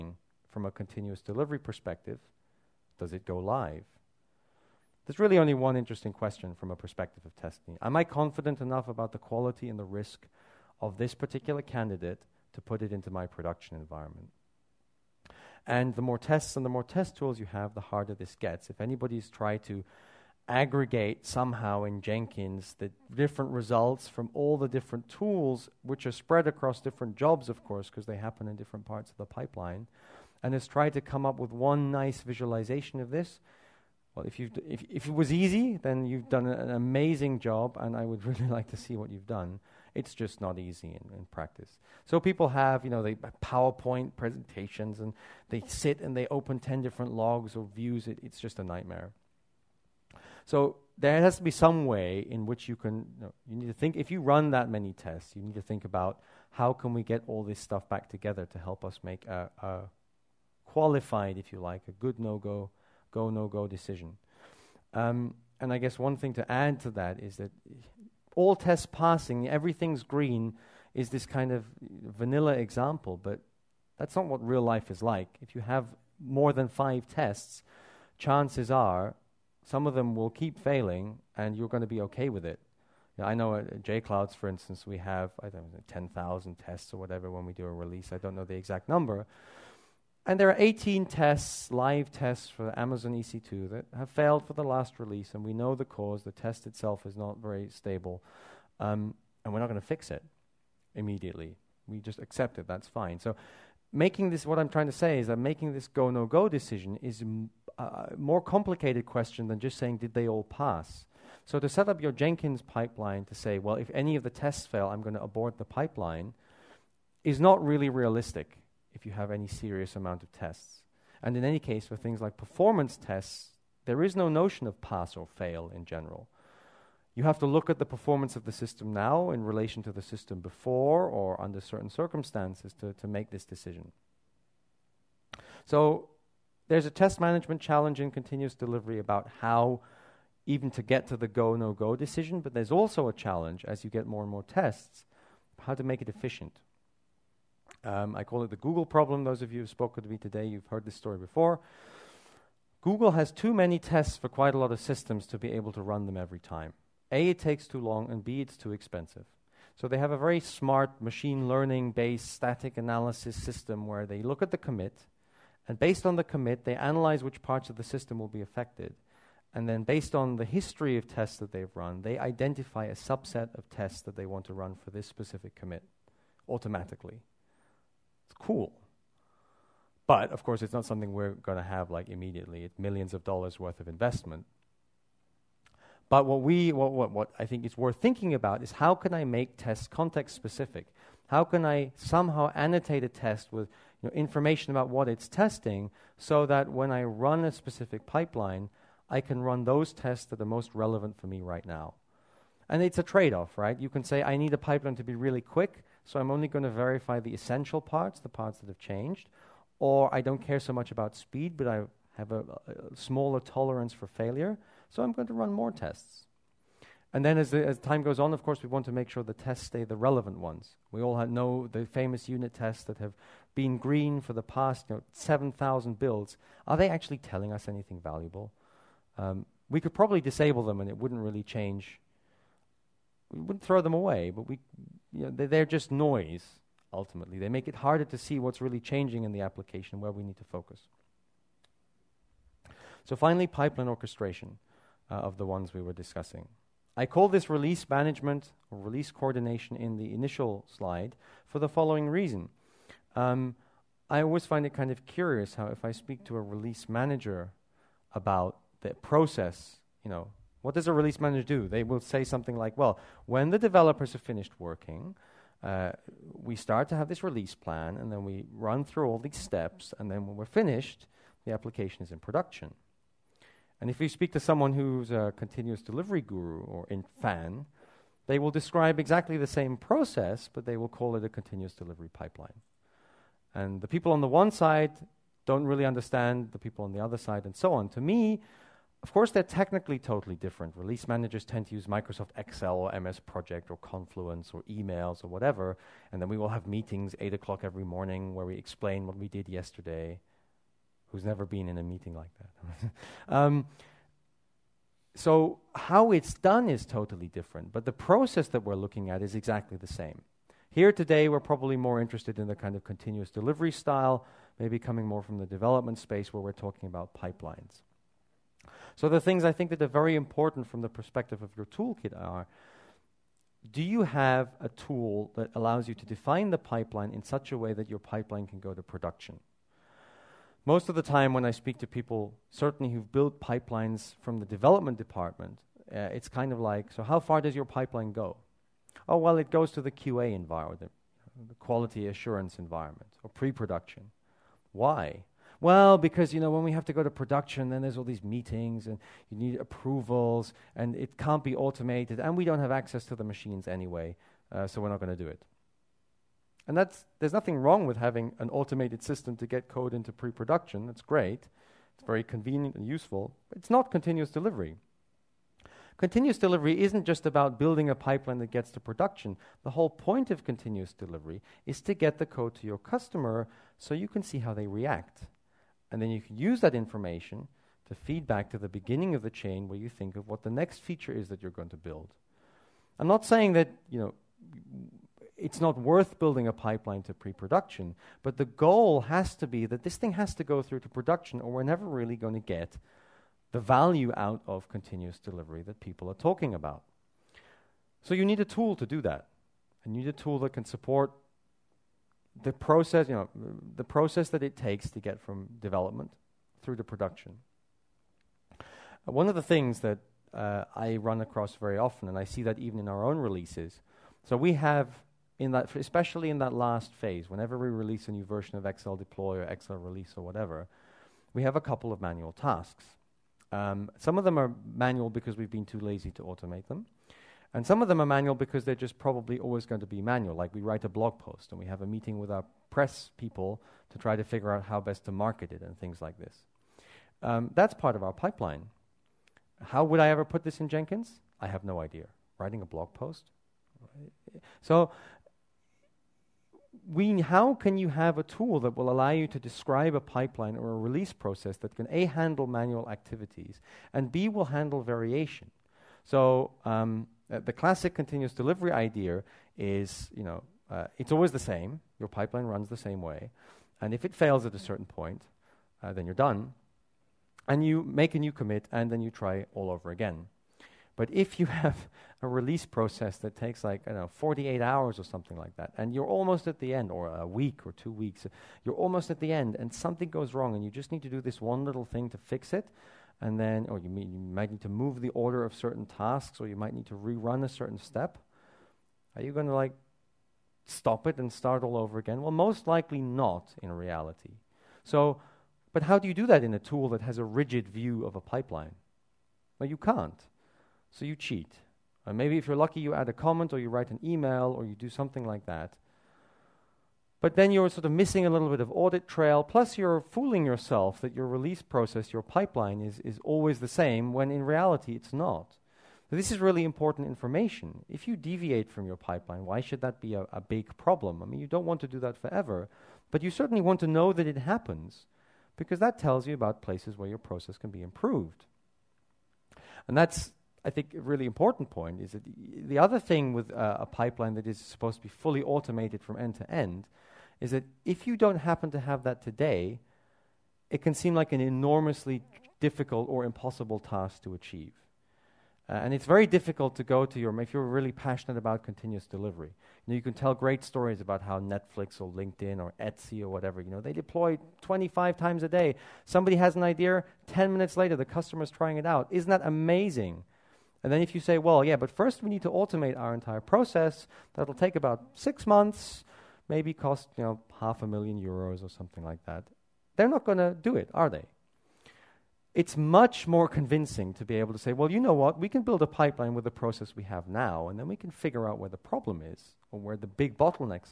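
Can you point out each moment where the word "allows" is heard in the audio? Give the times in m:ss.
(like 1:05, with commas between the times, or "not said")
5:25, 7:28.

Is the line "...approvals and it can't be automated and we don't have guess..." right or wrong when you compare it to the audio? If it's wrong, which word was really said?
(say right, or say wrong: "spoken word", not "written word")
wrong: "access", not "guess".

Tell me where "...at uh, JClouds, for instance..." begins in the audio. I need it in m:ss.
1:23.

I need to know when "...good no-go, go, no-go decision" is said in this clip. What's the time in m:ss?
1:01.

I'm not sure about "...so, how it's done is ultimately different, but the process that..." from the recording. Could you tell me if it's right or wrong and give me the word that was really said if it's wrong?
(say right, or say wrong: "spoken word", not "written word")
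wrong: "totally", not "ultimately".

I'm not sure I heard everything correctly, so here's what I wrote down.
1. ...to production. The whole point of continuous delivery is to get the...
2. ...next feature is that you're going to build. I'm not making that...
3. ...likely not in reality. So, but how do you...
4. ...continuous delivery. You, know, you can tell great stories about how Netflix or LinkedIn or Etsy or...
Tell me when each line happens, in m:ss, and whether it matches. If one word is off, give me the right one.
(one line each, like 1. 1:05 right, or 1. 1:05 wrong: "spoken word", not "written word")
1. 6:08 right
2. 6:20 wrong: "saying", not "making"
3. 8:12 right
4. 9:08 right.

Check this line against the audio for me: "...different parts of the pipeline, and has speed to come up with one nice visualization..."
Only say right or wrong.
wrong.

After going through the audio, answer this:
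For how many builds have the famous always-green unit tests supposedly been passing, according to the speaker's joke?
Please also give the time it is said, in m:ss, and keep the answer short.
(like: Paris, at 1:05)
7,000, at 3:45.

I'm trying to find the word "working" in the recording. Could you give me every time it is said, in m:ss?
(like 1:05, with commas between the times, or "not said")
4:24.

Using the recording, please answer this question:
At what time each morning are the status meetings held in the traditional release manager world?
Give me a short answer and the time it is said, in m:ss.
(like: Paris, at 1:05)
8 o'clock, at 4:57.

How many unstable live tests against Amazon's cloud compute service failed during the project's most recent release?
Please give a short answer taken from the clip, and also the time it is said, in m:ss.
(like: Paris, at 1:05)
18, at 1:30.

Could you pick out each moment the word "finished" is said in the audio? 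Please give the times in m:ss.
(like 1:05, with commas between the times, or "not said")
4:24, 4:30.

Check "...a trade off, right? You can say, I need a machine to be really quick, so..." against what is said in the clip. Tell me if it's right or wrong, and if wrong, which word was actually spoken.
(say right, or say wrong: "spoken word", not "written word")
wrong: "pipeline", not "machine".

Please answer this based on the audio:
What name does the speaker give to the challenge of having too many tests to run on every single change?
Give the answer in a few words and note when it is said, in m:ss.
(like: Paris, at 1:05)
the Google problem, at 2:28.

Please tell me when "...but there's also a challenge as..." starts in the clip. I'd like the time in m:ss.
2:22.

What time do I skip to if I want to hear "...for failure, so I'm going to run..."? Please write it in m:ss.
3:33.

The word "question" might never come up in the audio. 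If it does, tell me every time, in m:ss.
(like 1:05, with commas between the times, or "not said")
0:06, 1:49.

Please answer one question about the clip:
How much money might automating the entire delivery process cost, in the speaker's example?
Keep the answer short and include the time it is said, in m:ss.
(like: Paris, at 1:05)
half a million euros, at 9:27.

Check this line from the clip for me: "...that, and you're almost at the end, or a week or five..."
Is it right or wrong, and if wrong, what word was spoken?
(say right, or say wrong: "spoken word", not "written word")
wrong: "two", not "five".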